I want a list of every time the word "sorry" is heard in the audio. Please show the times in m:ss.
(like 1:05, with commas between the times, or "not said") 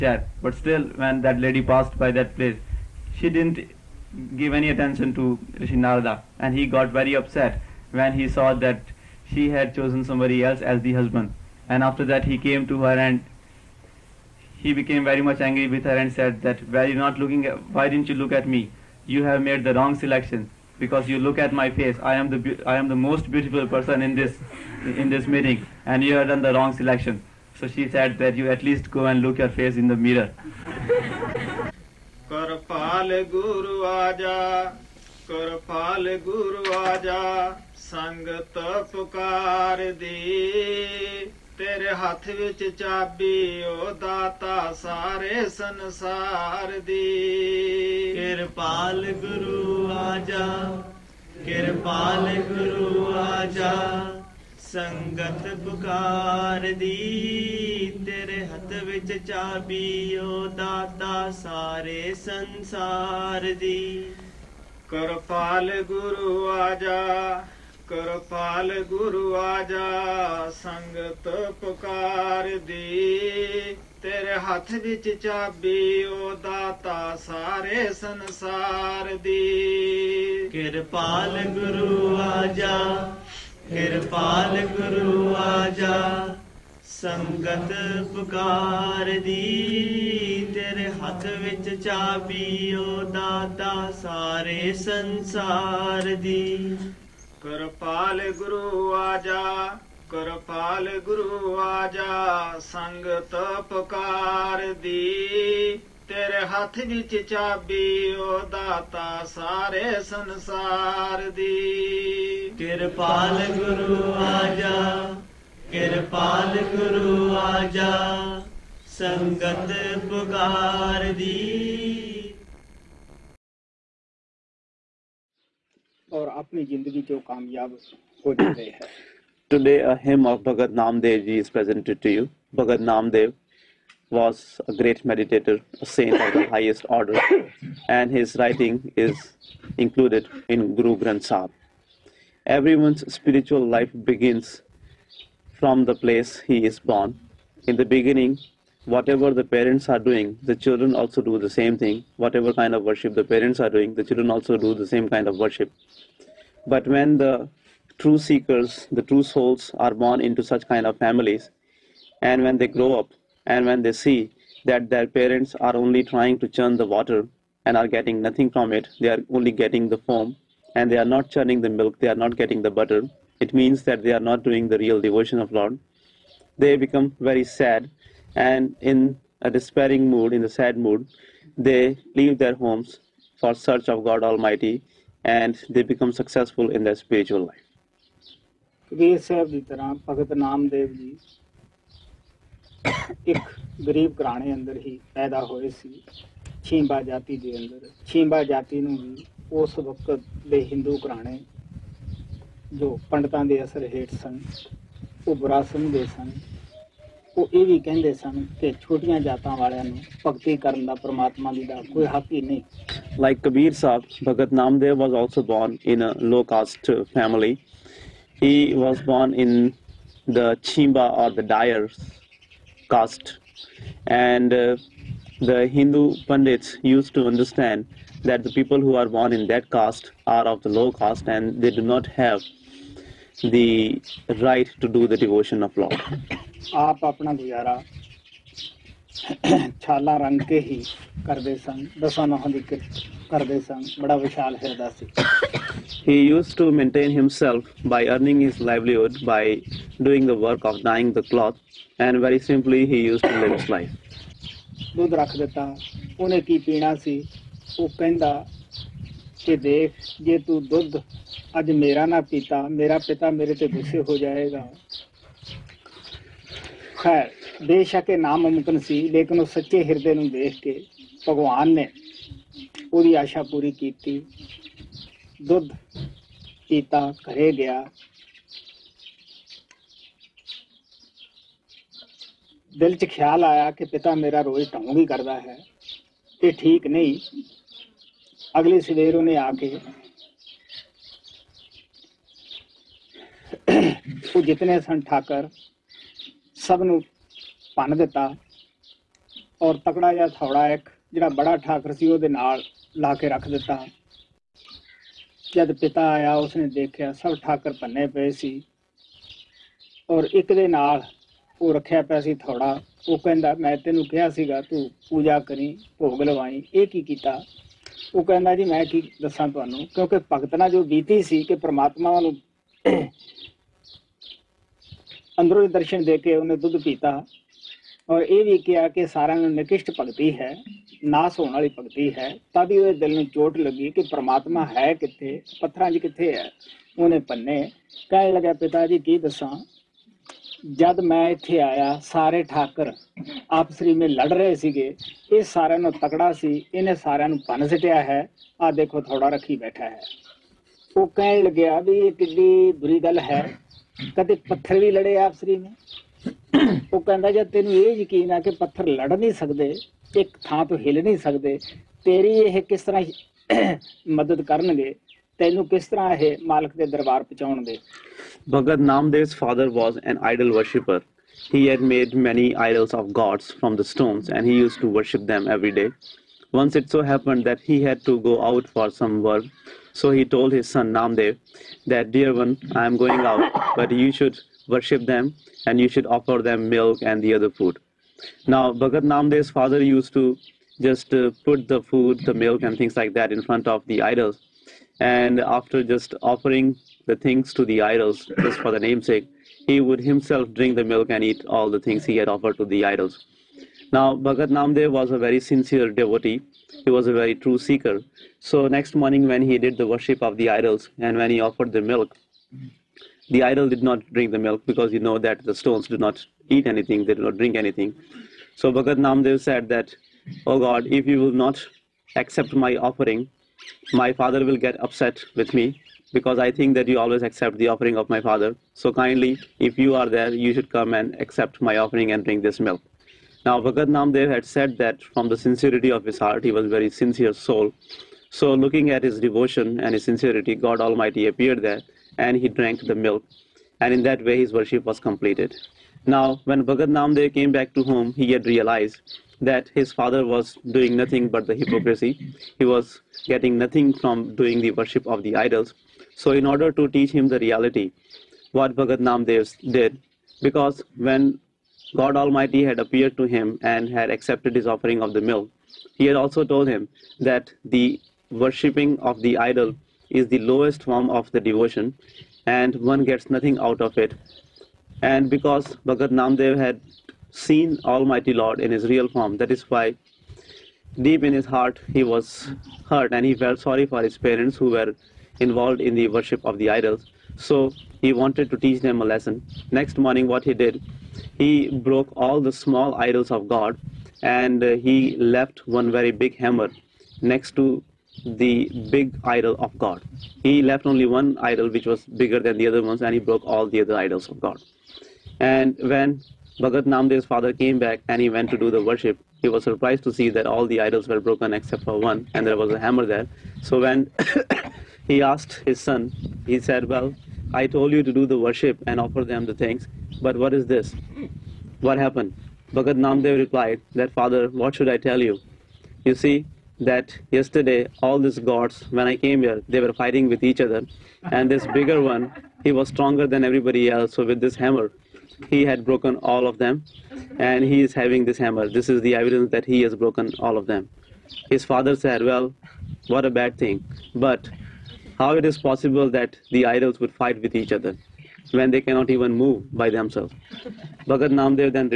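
8:03.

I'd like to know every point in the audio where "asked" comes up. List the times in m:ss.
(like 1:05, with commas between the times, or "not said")
8:35.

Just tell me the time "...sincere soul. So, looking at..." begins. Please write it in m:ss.
7:16.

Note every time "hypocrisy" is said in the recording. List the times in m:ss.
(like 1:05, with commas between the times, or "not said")
7:31.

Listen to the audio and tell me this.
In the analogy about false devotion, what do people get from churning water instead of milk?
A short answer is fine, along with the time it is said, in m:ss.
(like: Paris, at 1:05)
Foam, at 2:49.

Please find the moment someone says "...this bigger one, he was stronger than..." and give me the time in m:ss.
8:51.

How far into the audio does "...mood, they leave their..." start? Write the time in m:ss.
3:00.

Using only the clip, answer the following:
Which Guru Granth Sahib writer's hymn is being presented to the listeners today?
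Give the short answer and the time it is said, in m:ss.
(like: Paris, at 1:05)
Bhagat Namdev ji, at 2:10.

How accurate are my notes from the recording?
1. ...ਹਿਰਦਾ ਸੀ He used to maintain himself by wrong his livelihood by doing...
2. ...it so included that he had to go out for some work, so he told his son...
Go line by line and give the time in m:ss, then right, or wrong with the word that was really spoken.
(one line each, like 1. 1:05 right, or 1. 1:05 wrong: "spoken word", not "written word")
1. 4:04 wrong: "earning", not "wrong"
2. 6:16 wrong: "happened", not "included".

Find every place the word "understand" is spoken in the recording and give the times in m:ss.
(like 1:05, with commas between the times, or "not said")
3:47.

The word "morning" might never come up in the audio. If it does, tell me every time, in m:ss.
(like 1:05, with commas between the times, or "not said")
6:48, 8:09.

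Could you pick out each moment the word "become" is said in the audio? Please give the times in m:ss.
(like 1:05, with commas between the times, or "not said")
2:56, 3:05.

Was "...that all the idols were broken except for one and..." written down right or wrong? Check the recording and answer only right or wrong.
right.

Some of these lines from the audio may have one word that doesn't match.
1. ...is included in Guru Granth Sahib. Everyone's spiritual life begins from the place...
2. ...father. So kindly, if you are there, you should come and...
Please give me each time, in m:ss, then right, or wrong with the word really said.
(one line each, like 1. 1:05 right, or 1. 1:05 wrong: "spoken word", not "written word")
1. 2:19 right
2. 7:08 right.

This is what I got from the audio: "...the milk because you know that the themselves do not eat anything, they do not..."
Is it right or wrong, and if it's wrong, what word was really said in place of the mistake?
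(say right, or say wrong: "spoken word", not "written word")
wrong: "stones", not "themselves".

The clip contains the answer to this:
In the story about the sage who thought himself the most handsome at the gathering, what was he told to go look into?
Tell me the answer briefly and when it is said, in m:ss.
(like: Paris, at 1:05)
The mirror, at 0:29.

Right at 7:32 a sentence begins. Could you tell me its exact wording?
He was getting nothing from doing the worship of the idols.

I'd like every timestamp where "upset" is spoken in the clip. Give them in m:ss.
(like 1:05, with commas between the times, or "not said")
0:07, 7:04.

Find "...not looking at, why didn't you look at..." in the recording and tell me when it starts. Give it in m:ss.
0:16.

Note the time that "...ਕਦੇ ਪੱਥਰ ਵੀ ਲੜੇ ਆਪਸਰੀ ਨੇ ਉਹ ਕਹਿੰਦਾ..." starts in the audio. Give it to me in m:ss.
5:54.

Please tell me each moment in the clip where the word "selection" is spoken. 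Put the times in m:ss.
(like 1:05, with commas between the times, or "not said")
0:19, 0:26.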